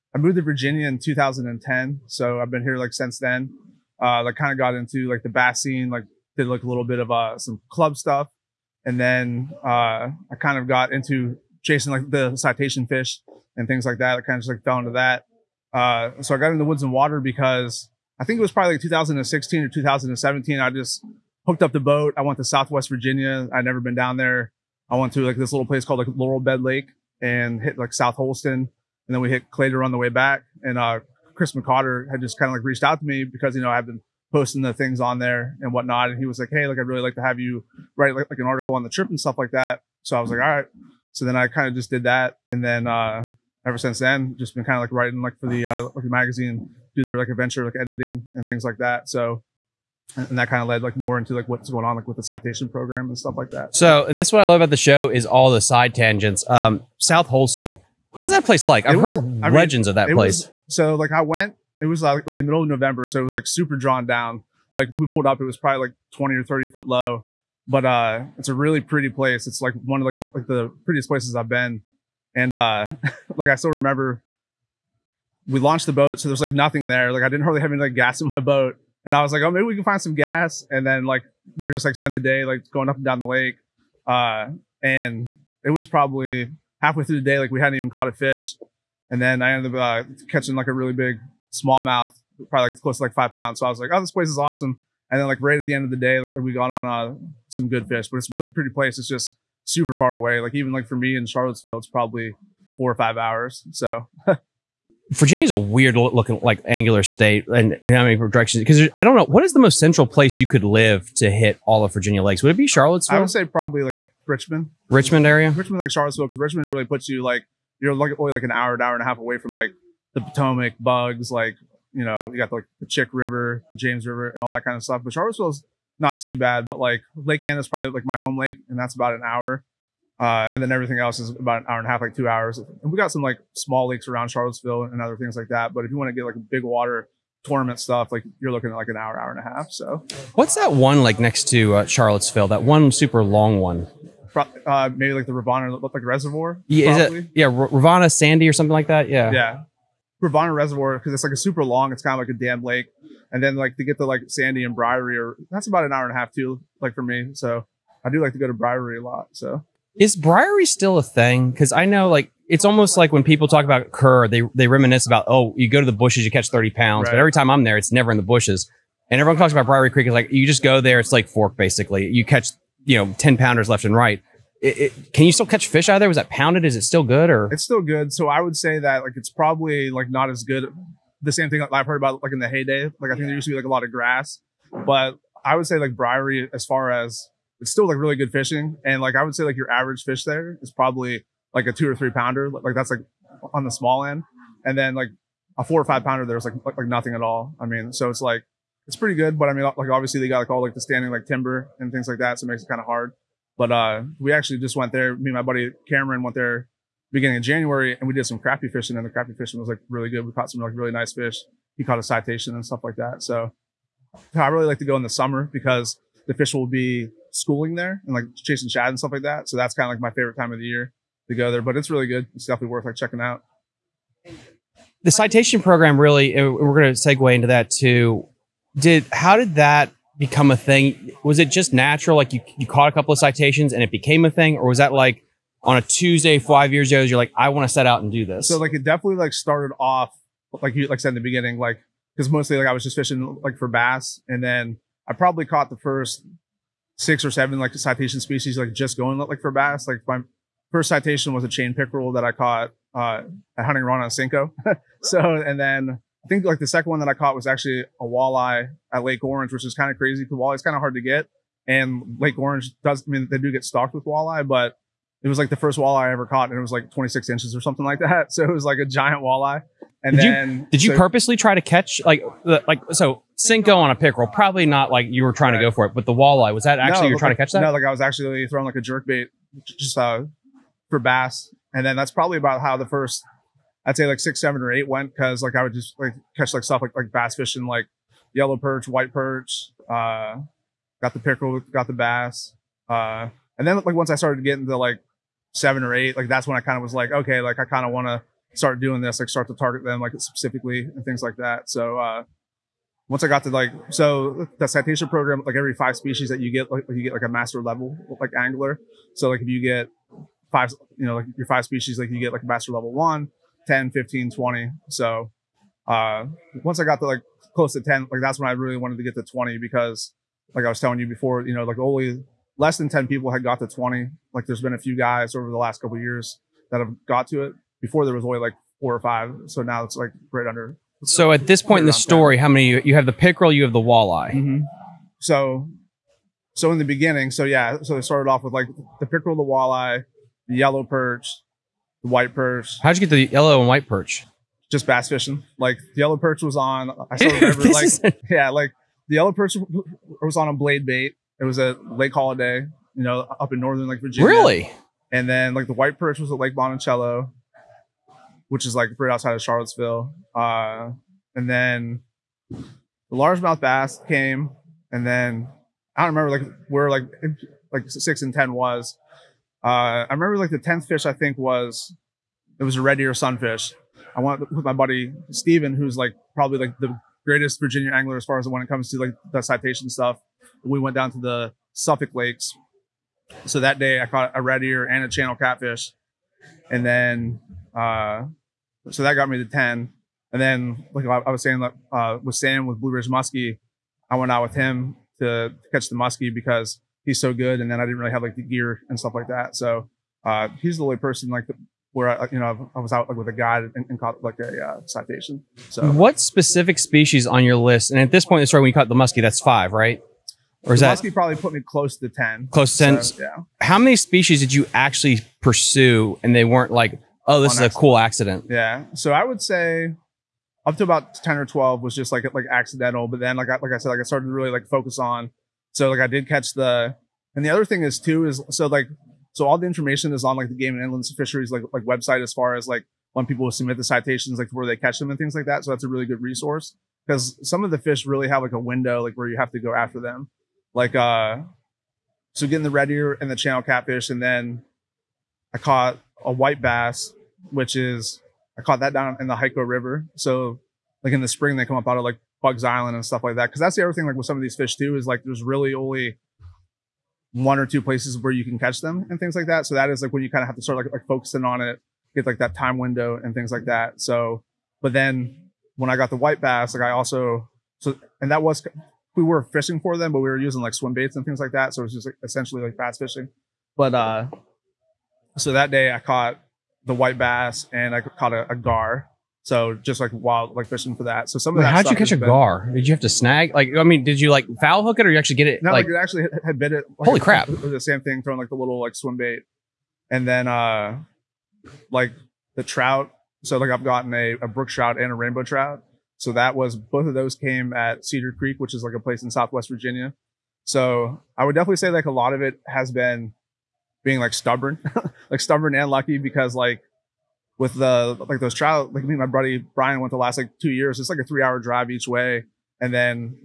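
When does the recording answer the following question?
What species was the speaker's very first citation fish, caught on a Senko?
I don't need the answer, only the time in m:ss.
4:11.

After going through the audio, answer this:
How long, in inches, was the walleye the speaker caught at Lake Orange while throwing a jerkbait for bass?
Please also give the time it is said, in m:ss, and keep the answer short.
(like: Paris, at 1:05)
26, at 4:26.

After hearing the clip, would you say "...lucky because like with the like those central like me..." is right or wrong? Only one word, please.
wrong.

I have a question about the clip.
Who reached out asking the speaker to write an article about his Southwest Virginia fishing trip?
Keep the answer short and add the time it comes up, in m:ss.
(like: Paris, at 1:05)
Chris McCotter, at 0:31.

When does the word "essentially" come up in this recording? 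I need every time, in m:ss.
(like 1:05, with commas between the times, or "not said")
7:52.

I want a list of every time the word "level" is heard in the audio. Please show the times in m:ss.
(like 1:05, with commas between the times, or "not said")
5:07, 5:12.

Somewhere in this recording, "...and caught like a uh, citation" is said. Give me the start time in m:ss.
6:43.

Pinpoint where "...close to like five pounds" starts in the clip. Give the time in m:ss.
1:32.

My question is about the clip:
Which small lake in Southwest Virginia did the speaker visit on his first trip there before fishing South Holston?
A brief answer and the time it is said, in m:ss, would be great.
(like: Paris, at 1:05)
Laurel Bed Lake, at 0:26.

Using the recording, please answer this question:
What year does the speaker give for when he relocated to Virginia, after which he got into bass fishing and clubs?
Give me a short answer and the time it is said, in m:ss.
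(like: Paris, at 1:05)
2010, at 0:00.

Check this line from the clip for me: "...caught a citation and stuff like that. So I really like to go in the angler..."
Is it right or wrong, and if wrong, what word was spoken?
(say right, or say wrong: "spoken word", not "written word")
wrong: "summer", not "angler".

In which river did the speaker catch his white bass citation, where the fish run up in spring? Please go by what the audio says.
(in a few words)
Hyco River.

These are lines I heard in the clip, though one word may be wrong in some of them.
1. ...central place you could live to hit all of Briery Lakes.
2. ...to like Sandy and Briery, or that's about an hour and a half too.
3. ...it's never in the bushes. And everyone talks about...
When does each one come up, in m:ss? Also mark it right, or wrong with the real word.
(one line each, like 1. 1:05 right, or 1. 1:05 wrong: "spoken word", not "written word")
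1. 1:49 wrong: "Virginia", not "Briery"
2. 2:33 right
3. 2:47 right.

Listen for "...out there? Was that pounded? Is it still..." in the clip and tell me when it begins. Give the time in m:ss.
2:55.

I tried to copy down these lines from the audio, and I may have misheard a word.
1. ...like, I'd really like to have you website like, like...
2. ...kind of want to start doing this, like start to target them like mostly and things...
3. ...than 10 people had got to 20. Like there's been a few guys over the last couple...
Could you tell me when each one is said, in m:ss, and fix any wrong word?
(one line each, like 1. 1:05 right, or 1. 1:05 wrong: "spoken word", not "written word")
1. 0:36 wrong: "write", not "website"
2. 4:57 wrong: "specifically", not "mostly"
3. 5:22 right.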